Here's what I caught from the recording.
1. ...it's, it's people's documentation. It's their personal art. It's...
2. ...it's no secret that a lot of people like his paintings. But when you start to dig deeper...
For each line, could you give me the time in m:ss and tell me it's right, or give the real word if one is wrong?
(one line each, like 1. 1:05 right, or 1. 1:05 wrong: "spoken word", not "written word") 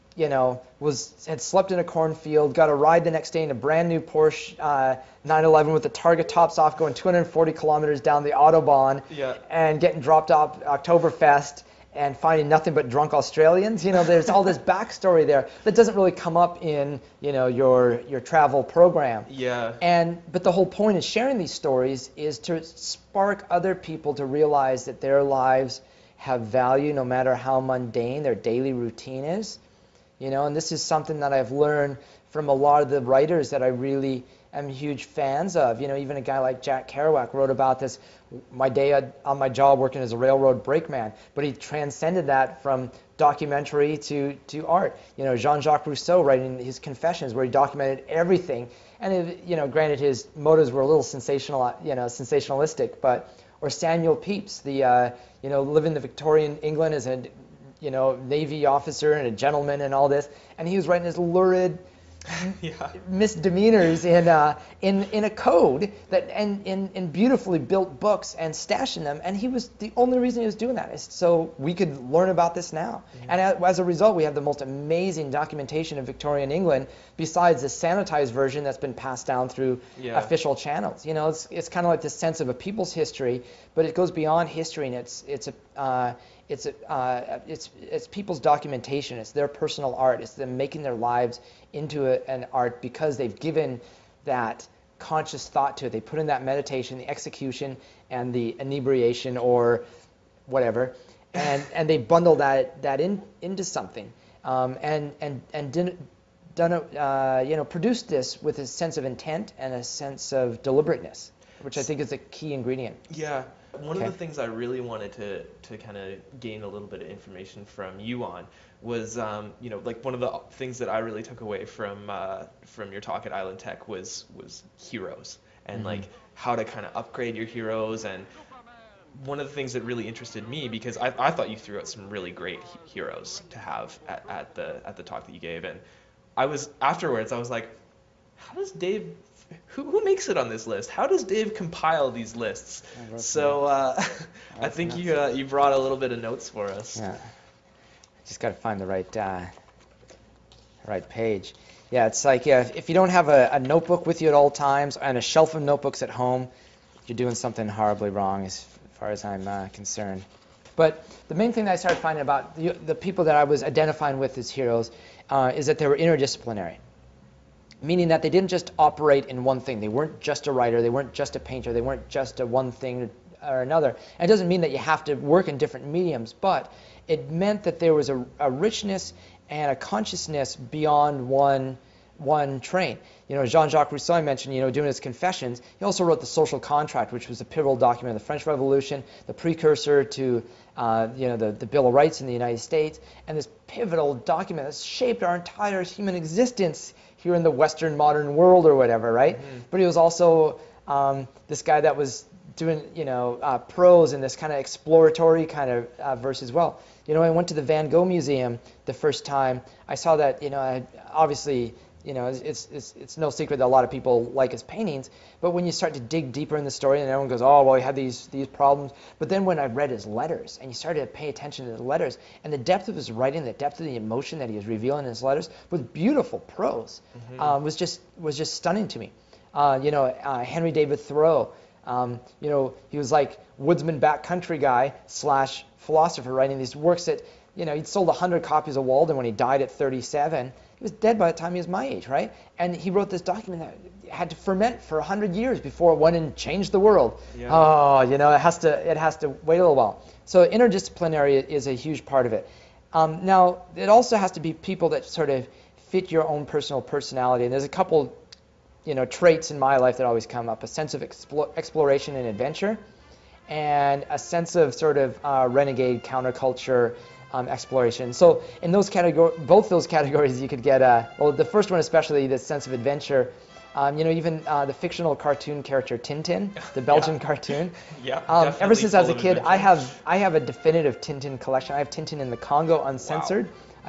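1. 1:27 right
2. 3:32 right.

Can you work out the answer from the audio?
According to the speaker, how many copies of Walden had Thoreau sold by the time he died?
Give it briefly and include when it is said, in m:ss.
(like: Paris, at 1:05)
100, at 3:58.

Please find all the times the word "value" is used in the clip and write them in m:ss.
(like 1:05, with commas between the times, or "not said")
0:26.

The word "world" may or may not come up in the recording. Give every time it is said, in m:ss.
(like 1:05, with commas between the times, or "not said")
3:18, 4:06.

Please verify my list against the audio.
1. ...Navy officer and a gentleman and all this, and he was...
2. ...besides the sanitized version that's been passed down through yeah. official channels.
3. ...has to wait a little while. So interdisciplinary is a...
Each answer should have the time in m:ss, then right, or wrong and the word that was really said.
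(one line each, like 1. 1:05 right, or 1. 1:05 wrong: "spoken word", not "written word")
1. 0:58 right
2. 1:17 right
3. 4:08 right.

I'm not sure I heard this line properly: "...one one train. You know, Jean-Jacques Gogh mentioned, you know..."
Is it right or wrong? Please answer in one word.
wrong.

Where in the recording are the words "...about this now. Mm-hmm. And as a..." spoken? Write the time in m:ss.
1:12.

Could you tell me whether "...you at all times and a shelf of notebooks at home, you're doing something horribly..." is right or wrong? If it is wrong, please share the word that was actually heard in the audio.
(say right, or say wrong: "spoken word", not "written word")
right.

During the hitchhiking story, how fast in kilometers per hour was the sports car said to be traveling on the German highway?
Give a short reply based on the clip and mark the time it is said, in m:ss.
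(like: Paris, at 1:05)
240, at 0:06.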